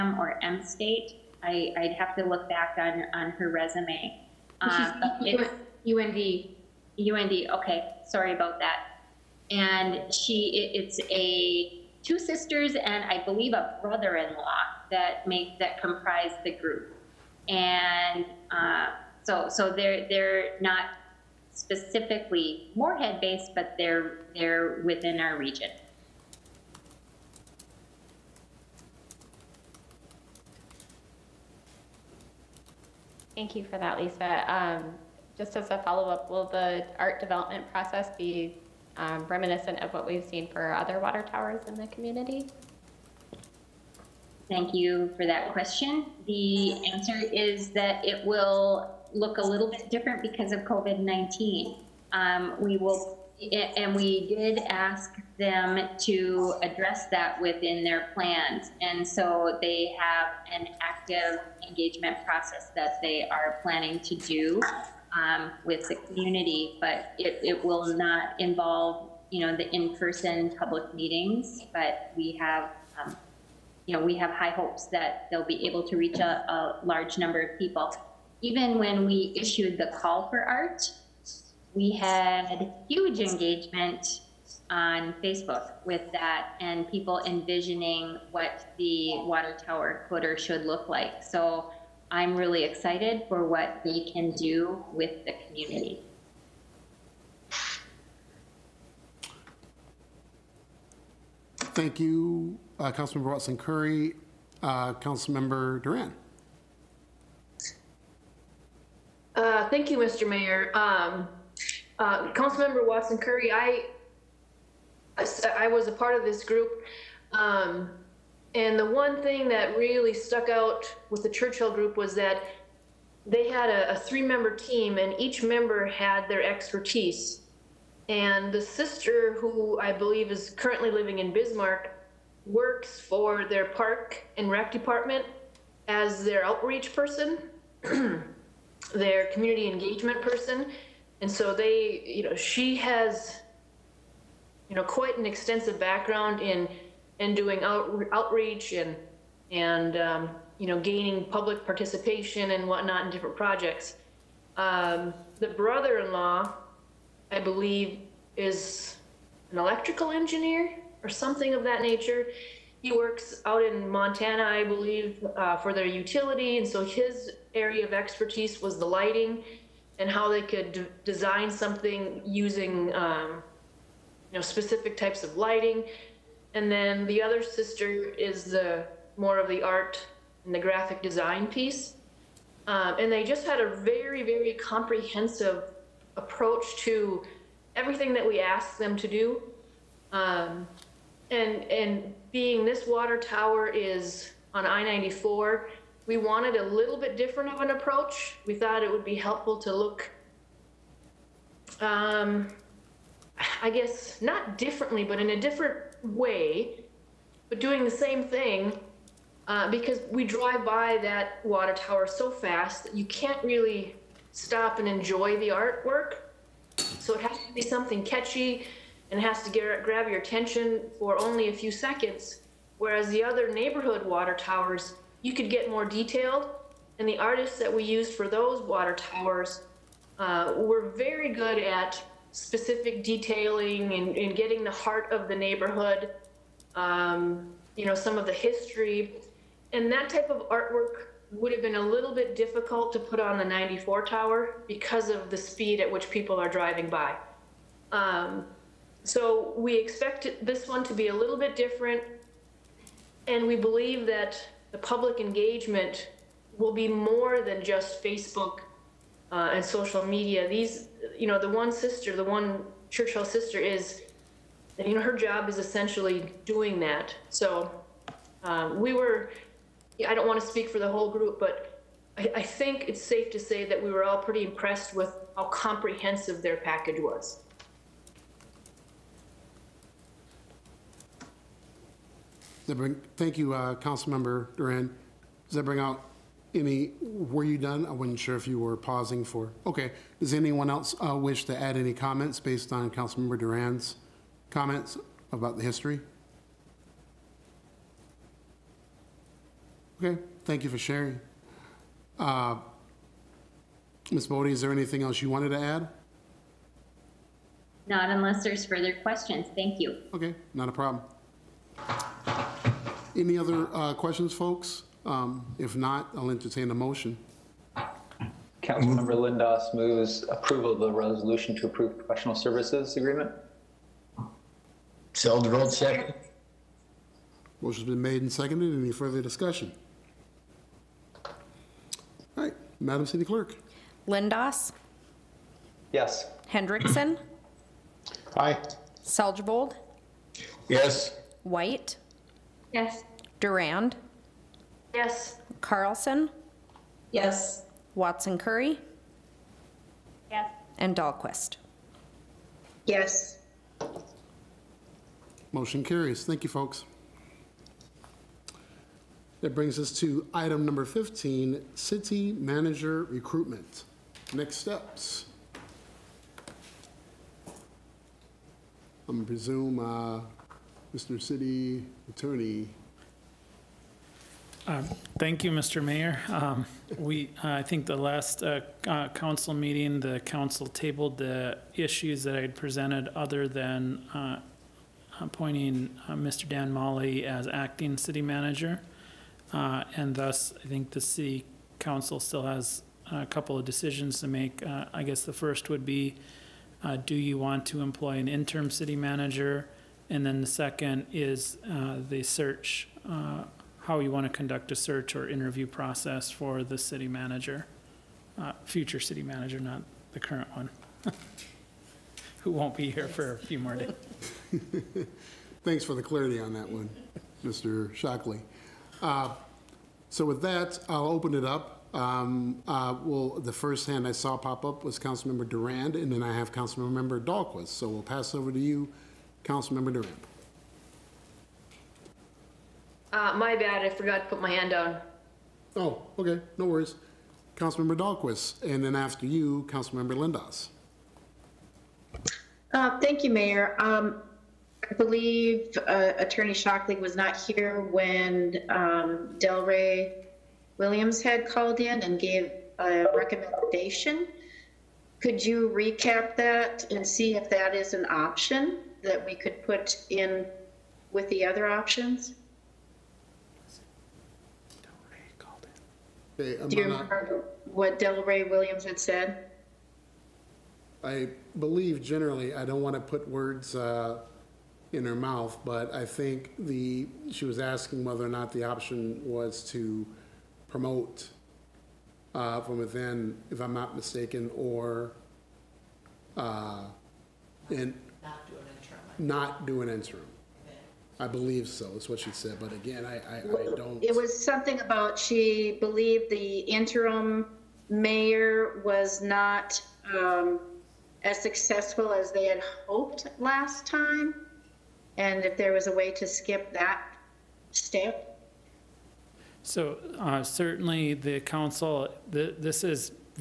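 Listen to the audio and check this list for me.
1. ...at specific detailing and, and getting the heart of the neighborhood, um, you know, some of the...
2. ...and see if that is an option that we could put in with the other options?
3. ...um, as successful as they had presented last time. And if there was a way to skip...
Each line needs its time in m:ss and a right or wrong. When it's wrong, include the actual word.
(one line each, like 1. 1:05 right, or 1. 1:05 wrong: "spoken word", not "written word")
1. 3:51 right
2. 7:36 right
3. 8:20 wrong: "hoped", not "presented".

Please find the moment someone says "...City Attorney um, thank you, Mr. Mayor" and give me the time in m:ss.
6:11.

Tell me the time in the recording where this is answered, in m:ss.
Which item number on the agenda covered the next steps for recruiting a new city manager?
6:00.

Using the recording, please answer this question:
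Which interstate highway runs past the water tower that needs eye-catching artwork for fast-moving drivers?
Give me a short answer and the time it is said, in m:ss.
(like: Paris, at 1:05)
I-94, at 3:14.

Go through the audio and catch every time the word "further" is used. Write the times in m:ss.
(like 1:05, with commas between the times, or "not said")
5:08, 5:28.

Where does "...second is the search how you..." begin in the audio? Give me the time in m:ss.
6:40.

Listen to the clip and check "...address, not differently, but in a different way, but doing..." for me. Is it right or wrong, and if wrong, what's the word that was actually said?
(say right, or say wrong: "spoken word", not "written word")
wrong: "guess", not "address".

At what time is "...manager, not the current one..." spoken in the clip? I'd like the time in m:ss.
6:49.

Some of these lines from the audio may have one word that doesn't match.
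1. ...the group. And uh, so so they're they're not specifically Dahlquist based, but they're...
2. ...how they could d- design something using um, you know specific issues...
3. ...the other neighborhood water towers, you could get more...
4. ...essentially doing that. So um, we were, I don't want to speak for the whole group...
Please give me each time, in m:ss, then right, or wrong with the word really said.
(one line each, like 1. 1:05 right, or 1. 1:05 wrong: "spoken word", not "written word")
1. 0:16 wrong: "Moorhead", not "Dahlquist"
2. 2:50 wrong: "types", not "issues"
3. 3:43 right
4. 4:25 right.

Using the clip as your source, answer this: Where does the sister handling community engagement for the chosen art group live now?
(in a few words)
Bismarck.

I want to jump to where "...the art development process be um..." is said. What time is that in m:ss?
0:36.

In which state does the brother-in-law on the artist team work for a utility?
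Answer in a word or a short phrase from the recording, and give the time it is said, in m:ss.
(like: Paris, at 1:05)
Montana, at 2:43.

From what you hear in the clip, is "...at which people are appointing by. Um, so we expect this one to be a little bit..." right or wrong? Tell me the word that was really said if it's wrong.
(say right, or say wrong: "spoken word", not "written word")
wrong: "driving", not "appointing".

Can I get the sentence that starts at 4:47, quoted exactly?
I wasn't sure if you were pausing for.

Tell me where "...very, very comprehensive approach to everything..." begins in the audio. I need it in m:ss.
3:03.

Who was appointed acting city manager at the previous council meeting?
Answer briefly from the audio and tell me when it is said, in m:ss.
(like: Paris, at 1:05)
Dan Mahli, at 6:26.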